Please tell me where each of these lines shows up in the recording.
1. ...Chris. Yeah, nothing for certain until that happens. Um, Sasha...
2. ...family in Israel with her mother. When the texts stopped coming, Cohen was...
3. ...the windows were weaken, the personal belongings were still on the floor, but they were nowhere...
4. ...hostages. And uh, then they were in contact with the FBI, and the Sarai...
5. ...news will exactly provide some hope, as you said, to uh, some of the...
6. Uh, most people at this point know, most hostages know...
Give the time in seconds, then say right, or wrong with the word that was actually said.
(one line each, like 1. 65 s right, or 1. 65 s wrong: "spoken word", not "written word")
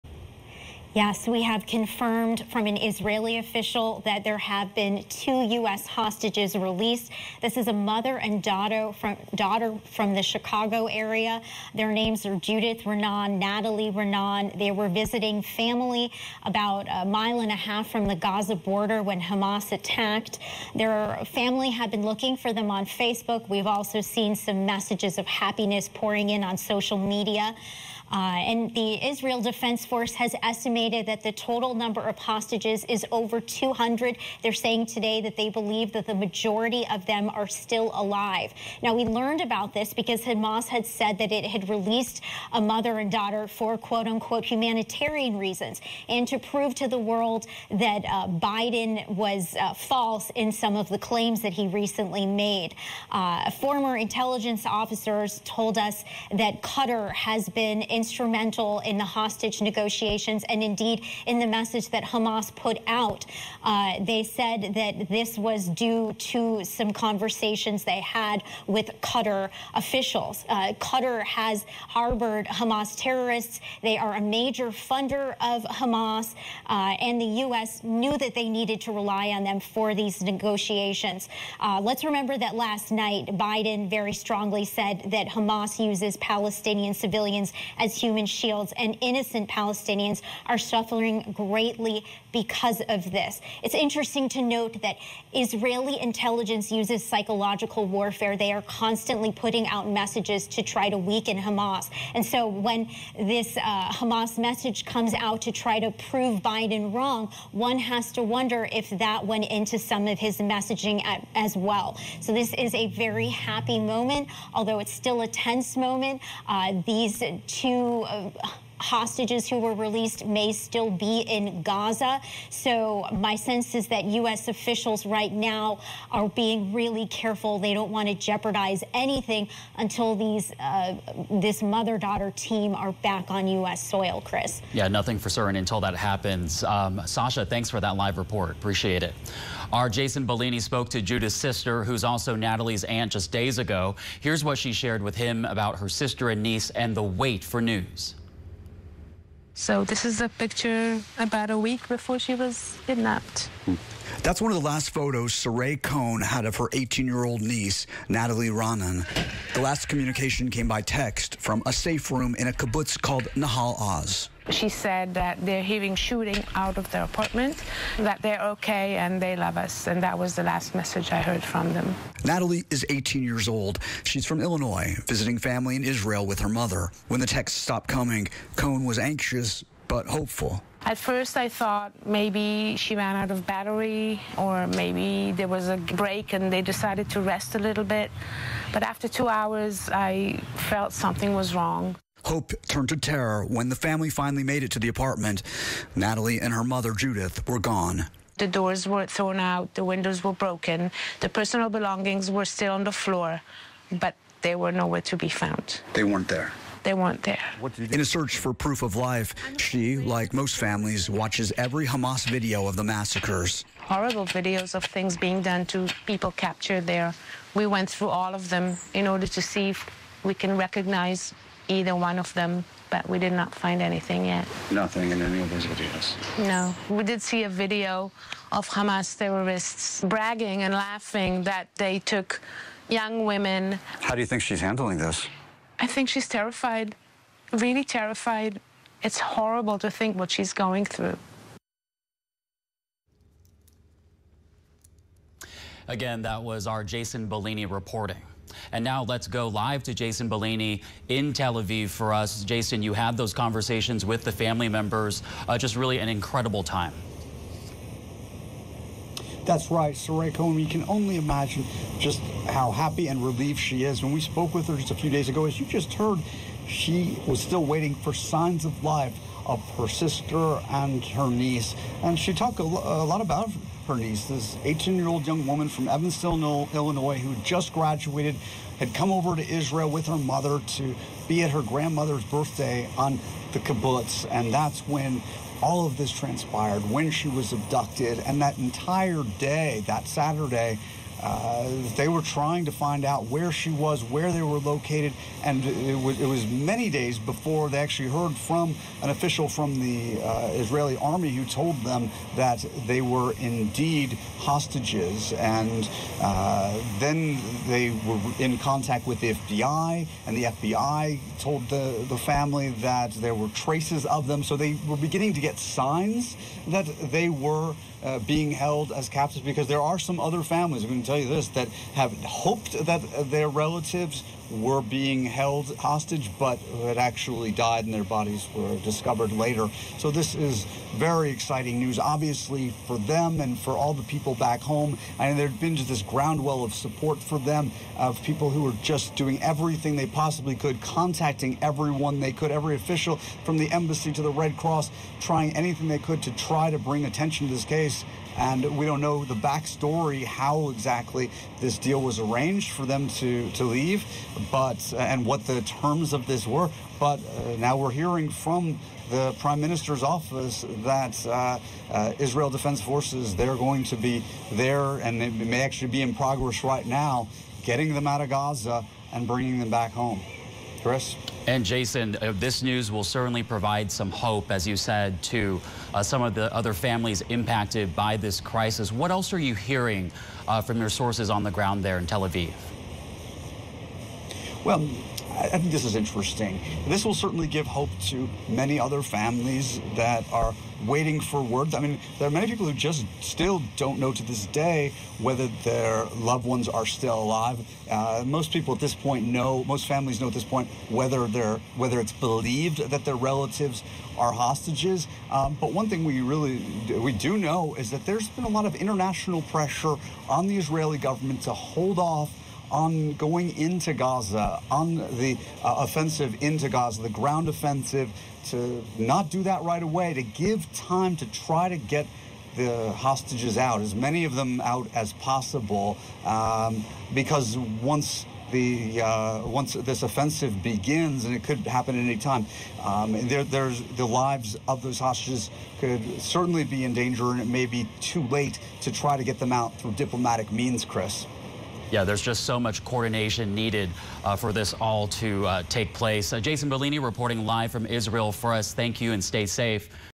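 1. 134 s right
2. 175 s right
3. 199 s wrong: "broken", not "weaken"
4. 304 s wrong: "FBI", not "Sarai"
5. 372 s wrong: "certainly", not "exactly"
6. 397 s wrong: "families", not "hostages".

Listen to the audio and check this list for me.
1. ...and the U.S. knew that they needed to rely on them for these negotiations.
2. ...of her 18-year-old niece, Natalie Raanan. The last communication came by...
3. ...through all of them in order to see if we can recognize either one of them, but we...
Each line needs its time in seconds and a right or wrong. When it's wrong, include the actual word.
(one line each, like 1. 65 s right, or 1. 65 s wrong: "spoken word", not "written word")
1. 77 s right
2. 156 s right
3. 217 s right.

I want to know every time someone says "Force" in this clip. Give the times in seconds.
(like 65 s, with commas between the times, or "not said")
29 s, 362 s.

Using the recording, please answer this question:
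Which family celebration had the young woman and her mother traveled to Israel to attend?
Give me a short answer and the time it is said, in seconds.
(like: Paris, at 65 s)
grandmother's birthday, at 281 s.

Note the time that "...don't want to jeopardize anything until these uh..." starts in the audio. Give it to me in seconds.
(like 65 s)
127 s.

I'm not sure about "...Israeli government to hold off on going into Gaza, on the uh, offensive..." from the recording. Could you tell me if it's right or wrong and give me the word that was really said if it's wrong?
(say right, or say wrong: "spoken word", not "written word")
right.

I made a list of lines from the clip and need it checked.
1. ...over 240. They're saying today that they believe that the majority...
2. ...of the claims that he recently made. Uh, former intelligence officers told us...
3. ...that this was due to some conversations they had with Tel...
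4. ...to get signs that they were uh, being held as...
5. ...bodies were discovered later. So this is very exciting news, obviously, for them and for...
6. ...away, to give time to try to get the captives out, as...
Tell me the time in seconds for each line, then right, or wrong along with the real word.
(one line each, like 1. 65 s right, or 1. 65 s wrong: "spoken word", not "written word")
1. 33 s wrong: "200", not "240"
2. 50 s right
3. 64 s wrong: "Qatar", not "Tel"
4. 315 s right
5. 328 s right
6. 419 s wrong: "hostages", not "captives".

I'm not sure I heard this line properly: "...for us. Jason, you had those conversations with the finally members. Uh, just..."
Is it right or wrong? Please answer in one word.
wrong.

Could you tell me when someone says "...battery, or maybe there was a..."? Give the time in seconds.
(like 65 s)
183 s.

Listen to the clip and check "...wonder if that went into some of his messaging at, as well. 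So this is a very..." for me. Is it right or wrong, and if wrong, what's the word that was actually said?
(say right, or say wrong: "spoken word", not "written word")
right.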